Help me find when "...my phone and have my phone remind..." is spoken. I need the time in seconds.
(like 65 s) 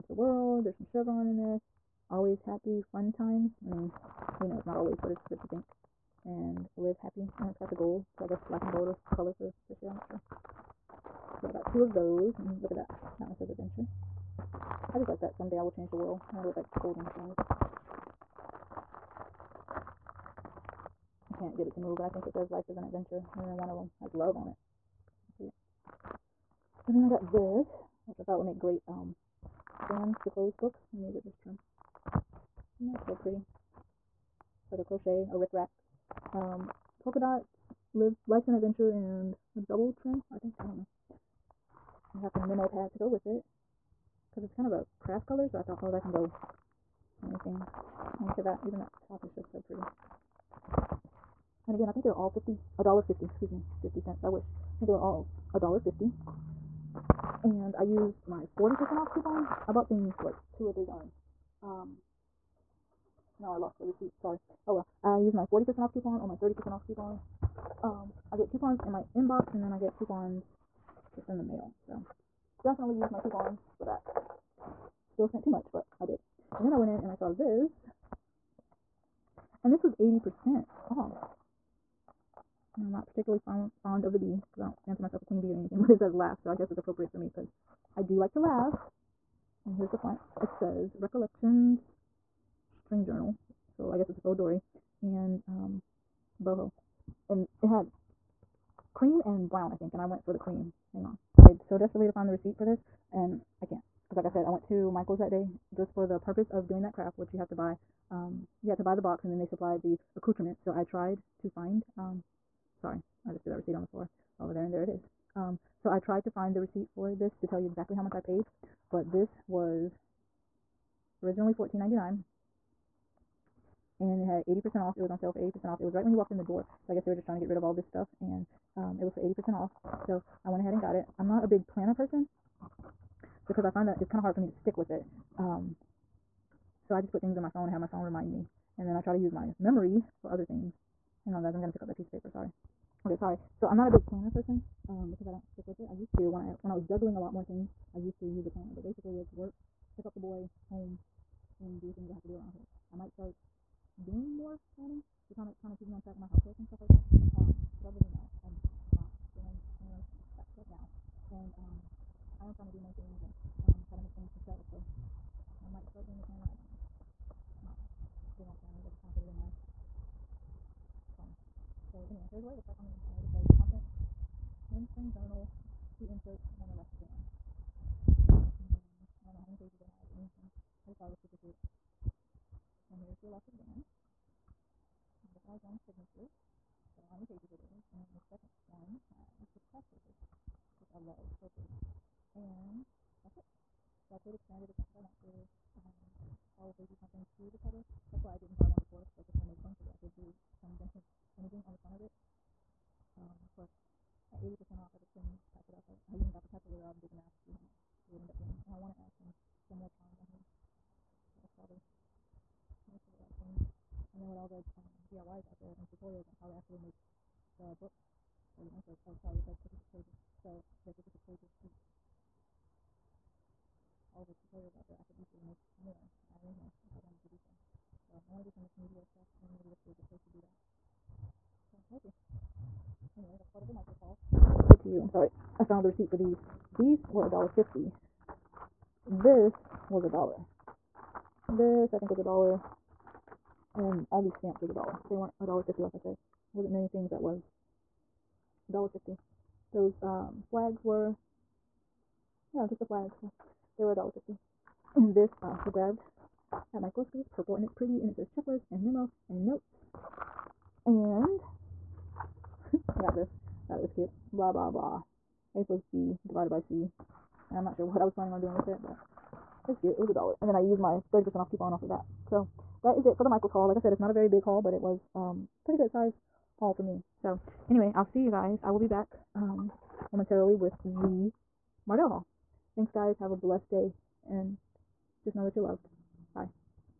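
137 s.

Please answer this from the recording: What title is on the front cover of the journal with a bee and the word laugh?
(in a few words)
Recollections String Journal.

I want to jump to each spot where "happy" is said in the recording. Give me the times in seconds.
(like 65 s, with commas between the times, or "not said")
2 s, 6 s.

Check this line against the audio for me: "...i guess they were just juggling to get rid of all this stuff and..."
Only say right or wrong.
wrong.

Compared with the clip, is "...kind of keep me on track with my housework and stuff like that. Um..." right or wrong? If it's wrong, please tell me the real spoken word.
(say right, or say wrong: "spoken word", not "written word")
right.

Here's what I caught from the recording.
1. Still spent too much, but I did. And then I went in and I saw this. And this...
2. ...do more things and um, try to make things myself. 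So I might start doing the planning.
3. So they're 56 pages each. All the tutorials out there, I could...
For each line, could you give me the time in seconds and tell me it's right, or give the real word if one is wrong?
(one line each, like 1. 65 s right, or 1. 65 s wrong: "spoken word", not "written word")
1. 75 s right
2. 162 s right
3. 220 s right.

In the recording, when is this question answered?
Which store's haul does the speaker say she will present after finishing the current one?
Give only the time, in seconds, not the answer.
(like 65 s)
281 s.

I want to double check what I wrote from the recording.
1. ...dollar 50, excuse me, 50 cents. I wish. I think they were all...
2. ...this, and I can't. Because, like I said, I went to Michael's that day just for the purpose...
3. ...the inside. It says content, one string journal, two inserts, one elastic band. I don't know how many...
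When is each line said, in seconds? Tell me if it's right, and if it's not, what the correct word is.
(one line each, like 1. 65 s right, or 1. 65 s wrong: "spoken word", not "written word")
1. 52 s right
2. 102 s right
3. 172 s right.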